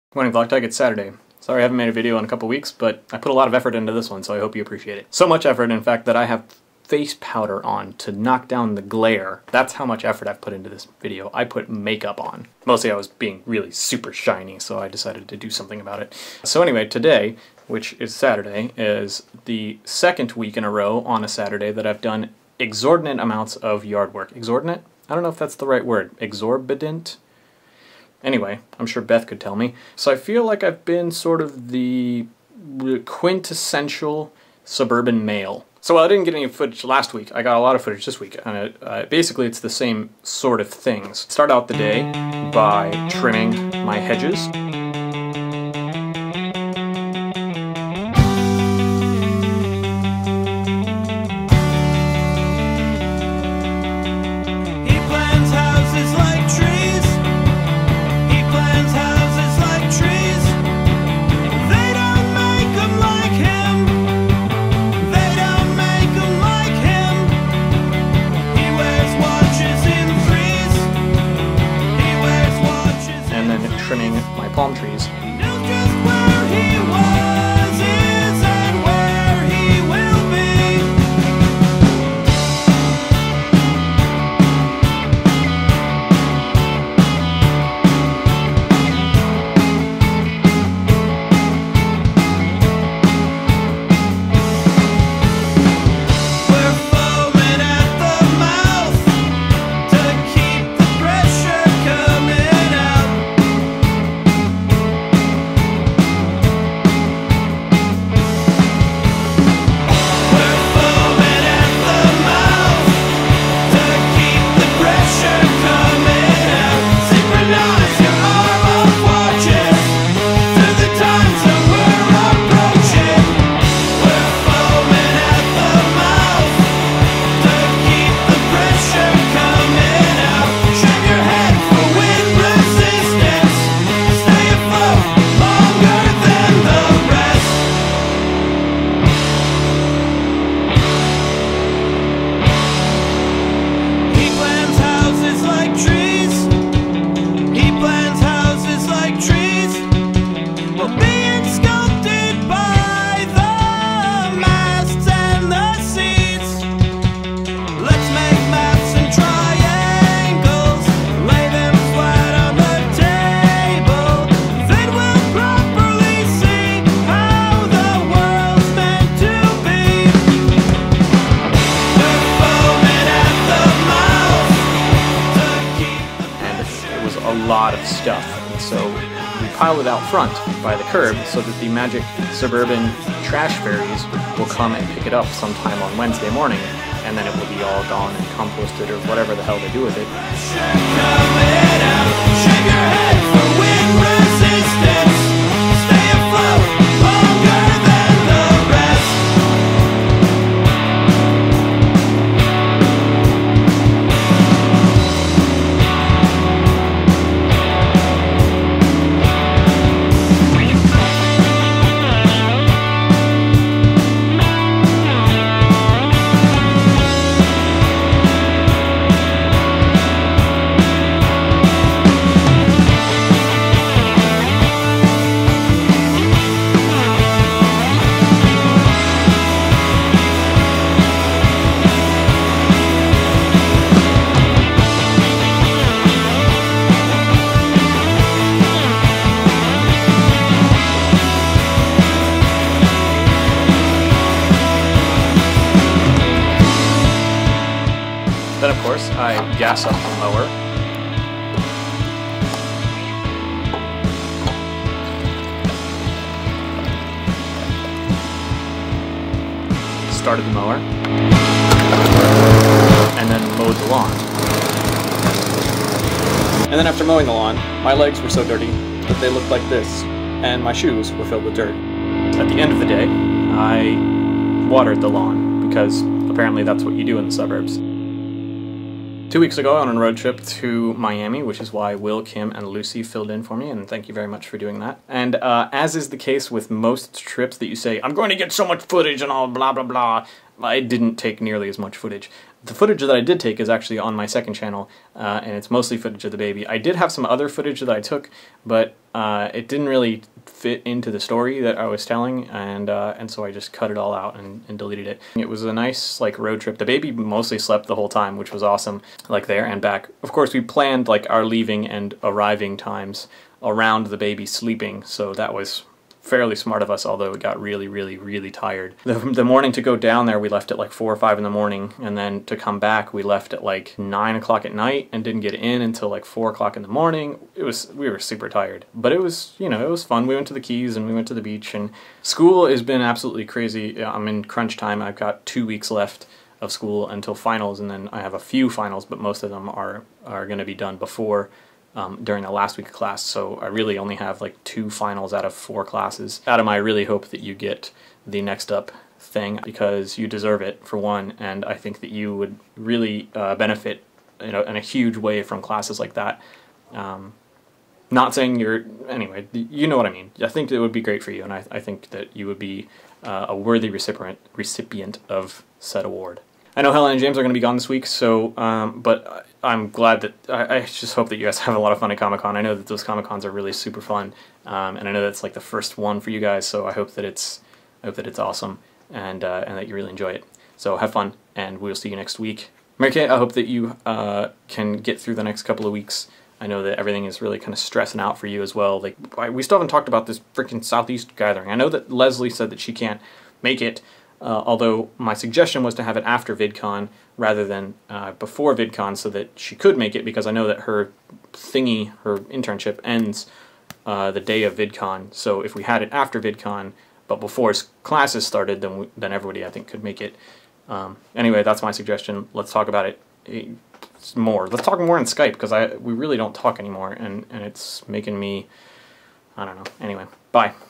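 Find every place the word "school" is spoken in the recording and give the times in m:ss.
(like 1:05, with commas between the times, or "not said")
5:32, 5:36.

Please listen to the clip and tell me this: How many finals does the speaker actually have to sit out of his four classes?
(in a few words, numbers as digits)
2.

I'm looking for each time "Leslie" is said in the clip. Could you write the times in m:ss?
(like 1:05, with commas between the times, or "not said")
6:32.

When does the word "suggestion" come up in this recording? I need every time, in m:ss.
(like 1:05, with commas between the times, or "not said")
6:35, 6:51.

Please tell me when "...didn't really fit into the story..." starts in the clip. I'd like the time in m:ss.
4:59.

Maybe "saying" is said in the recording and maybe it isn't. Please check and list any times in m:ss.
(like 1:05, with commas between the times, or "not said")
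5:58.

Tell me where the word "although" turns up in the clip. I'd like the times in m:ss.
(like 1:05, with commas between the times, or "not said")
5:17, 6:34.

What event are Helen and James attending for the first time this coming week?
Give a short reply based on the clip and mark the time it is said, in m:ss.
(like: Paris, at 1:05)
Comic Con, at 6:12.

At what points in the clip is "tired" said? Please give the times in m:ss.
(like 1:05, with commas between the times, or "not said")
5:18, 5:28.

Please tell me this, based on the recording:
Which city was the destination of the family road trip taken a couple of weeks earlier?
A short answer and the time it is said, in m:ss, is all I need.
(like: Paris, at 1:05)
Miami, at 4:40.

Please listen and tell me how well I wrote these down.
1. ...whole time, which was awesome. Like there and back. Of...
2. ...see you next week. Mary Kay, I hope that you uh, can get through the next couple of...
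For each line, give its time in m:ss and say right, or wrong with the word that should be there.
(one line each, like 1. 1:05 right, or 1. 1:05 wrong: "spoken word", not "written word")
1. 5:07 right
2. 6:21 right.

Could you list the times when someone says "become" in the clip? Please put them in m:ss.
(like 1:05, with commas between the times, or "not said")
not said.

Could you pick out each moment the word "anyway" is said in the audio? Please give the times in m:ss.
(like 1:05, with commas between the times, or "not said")
0:16, 0:28, 5:59, 6:51, 7:00.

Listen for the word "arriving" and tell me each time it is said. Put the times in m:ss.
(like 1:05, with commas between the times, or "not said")
5:12.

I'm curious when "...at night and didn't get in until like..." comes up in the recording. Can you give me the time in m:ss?
5:24.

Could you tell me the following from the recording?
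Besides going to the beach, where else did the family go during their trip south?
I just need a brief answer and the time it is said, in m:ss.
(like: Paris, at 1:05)
the Keys, at 5:30.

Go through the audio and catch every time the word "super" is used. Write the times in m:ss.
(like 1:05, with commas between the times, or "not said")
0:13, 5:28, 6:13.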